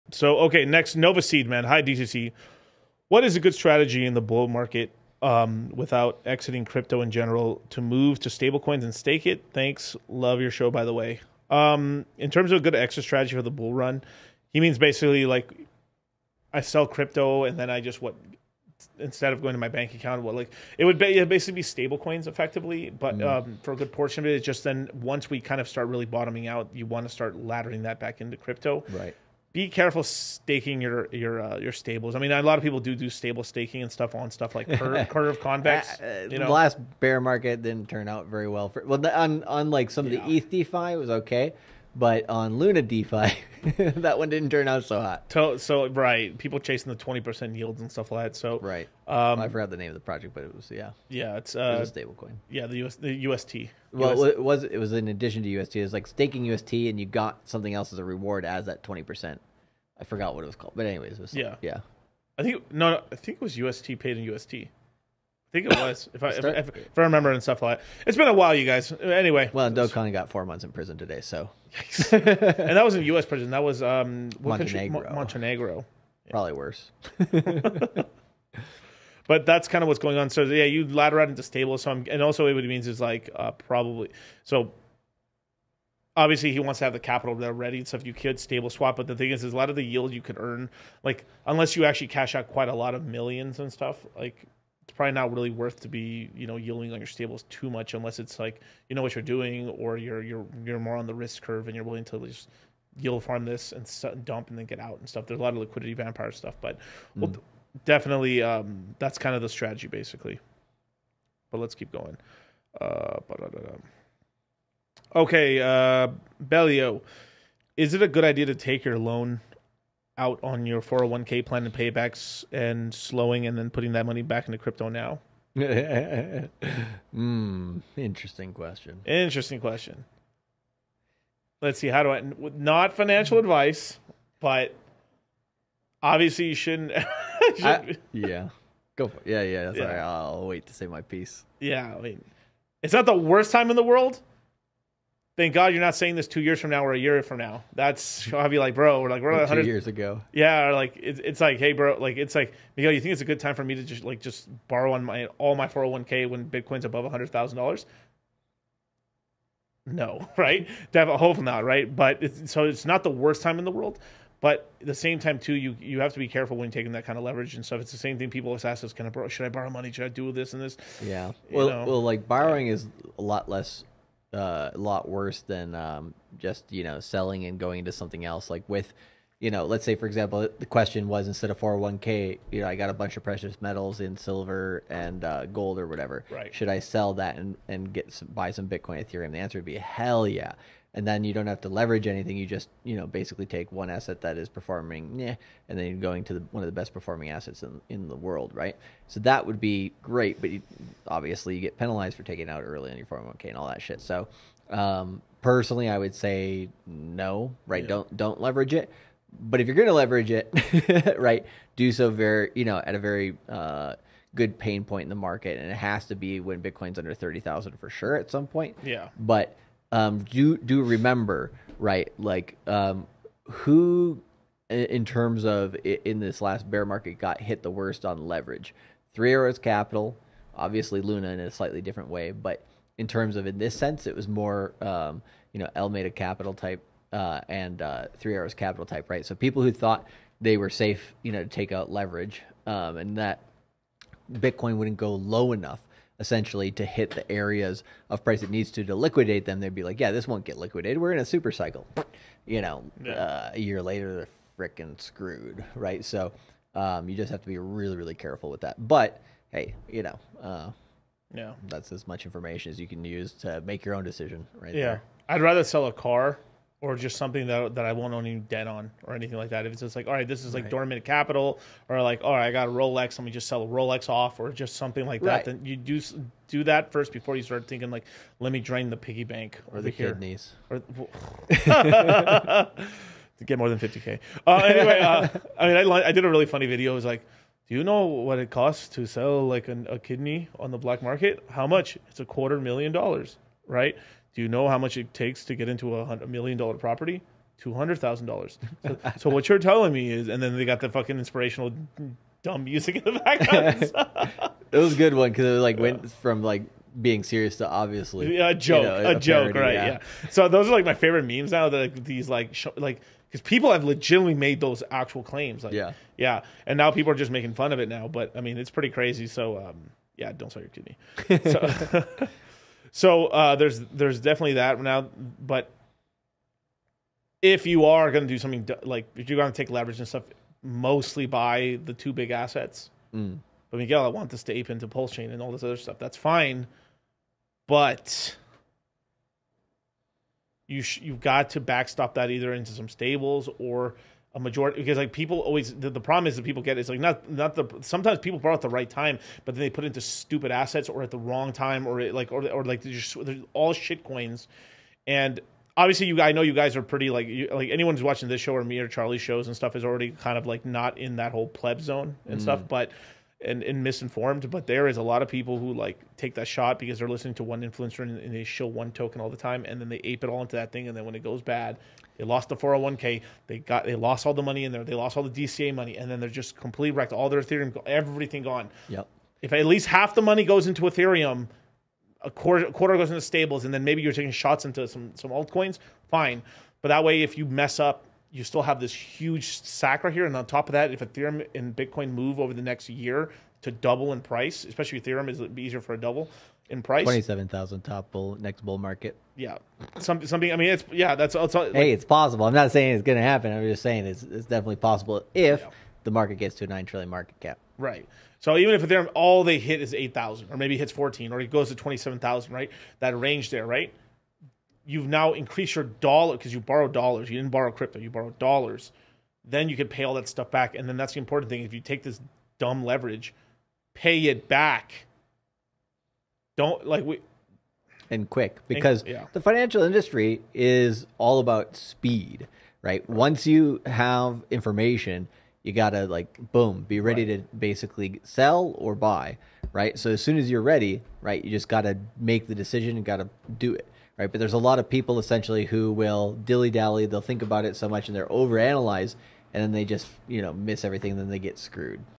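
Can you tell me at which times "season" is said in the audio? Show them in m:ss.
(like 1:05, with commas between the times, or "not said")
not said.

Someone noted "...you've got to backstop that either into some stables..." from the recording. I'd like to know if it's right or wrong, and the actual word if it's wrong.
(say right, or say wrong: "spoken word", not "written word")
right.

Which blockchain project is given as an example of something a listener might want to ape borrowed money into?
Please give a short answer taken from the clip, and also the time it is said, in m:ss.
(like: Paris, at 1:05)
Pulse Chain, at 5:34.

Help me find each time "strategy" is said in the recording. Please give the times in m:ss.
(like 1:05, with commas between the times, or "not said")
0:03, 0:13, 1:49.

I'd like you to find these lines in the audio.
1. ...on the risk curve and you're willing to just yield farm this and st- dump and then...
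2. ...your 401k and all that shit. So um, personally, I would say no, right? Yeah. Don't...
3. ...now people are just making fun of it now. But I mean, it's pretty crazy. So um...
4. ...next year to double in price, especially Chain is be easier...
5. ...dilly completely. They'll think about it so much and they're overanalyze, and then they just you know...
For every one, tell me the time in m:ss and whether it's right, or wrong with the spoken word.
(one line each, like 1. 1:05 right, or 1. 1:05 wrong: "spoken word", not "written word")
1. 1:40 right
2. 3:22 right
3. 5:16 right
4. 6:32 wrong: "Ethereum", not "Chain"
5. 7:26 wrong: "dally", not "completely".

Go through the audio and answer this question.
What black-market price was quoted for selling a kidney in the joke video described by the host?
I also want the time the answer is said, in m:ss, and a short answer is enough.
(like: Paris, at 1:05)
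$250,000, at 4:52.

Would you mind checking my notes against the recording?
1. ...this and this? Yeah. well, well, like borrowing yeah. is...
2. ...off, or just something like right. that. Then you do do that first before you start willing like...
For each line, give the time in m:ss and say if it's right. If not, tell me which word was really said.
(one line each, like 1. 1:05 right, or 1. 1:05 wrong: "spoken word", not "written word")
1. 2:50 right
2. 4:34 wrong: "thinking", not "willing".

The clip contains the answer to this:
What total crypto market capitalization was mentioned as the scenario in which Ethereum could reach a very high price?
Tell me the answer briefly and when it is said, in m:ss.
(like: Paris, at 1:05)
9 trillion, at 6:46.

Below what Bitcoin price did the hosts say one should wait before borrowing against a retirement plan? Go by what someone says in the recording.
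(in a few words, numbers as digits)
30,000.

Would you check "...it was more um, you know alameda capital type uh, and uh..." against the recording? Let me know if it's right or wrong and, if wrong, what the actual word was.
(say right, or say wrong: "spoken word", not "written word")
right.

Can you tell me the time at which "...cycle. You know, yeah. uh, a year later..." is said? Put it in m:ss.
4:11.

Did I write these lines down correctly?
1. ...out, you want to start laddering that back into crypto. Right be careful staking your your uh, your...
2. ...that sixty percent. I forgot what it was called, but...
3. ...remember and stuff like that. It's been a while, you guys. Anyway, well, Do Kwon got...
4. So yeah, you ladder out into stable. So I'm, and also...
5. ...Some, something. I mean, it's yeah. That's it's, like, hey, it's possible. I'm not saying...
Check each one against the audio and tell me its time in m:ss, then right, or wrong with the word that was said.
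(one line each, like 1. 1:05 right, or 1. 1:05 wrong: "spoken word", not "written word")
1. 0:26 right
2. 0:58 wrong: "twenty", not "sixty"
3. 1:07 right
4. 1:20 right
5. 6:39 right.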